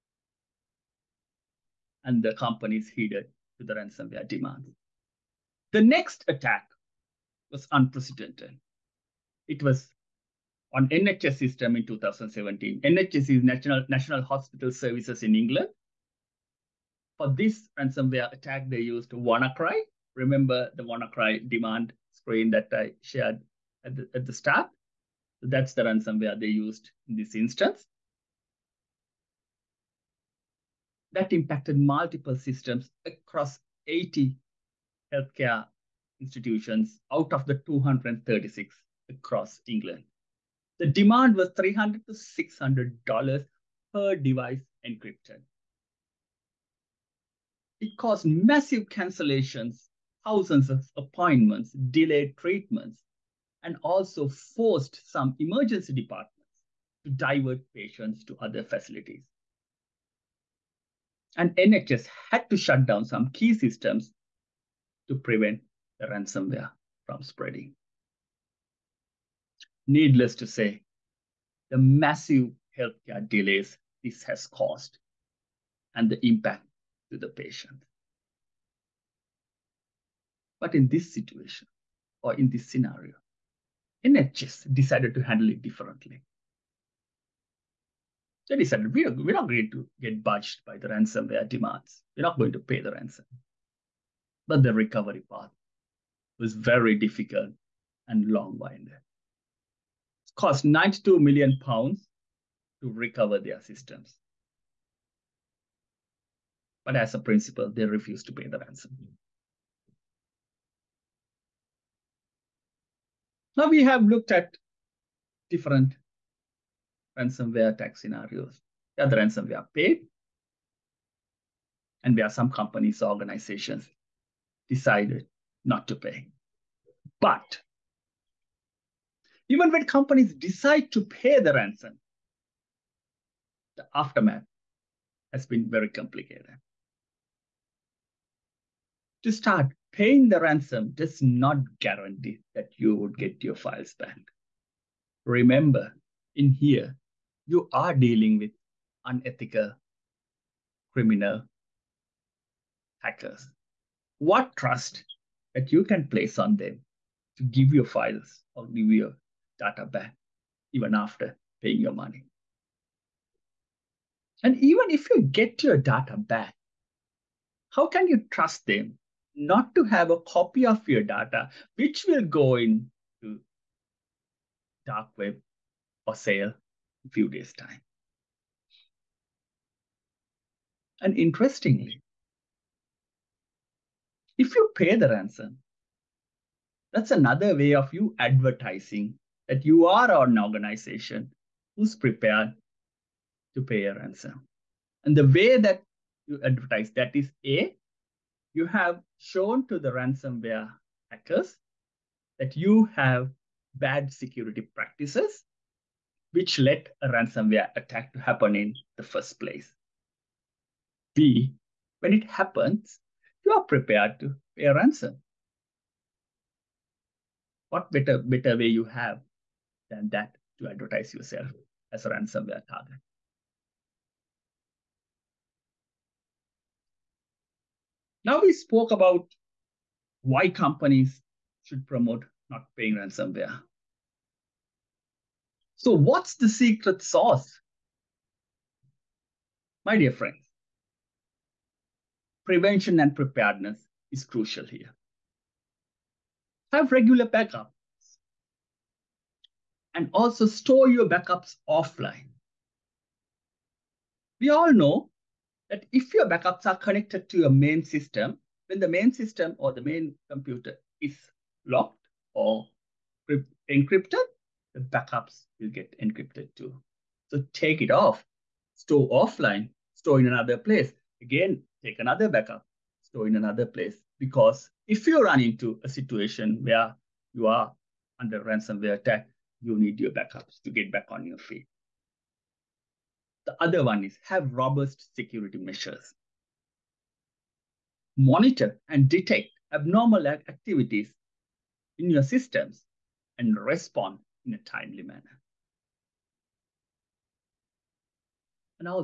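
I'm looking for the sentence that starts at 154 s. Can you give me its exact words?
What trust that you can place on them to give your files or give your data back even after paying your money.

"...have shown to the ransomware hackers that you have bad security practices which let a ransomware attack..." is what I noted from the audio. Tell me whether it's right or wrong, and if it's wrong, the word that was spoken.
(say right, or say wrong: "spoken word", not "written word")
right.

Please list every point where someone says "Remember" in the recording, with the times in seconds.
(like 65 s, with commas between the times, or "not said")
20 s, 145 s.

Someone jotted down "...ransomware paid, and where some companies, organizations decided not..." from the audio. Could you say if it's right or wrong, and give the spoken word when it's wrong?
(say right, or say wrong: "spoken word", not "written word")
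right.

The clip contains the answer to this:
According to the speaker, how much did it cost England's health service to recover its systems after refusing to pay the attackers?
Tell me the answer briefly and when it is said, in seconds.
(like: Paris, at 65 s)
92 million pounds, at 100 s.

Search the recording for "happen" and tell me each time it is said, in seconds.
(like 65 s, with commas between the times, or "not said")
208 s, 212 s.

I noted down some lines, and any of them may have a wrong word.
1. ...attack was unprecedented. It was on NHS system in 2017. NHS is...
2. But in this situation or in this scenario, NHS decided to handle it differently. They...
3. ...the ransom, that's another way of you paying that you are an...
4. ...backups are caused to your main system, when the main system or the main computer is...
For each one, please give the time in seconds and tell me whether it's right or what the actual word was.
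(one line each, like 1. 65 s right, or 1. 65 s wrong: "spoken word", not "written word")
1. 6 s right
2. 80 s right
3. 184 s wrong: "advertising", not "paying"
4. 256 s wrong: "connected", not "caused".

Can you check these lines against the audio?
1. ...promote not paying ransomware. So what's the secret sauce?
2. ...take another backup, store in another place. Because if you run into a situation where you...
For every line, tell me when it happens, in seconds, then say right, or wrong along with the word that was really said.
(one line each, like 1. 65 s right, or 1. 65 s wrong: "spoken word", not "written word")
1. 231 s right
2. 271 s right.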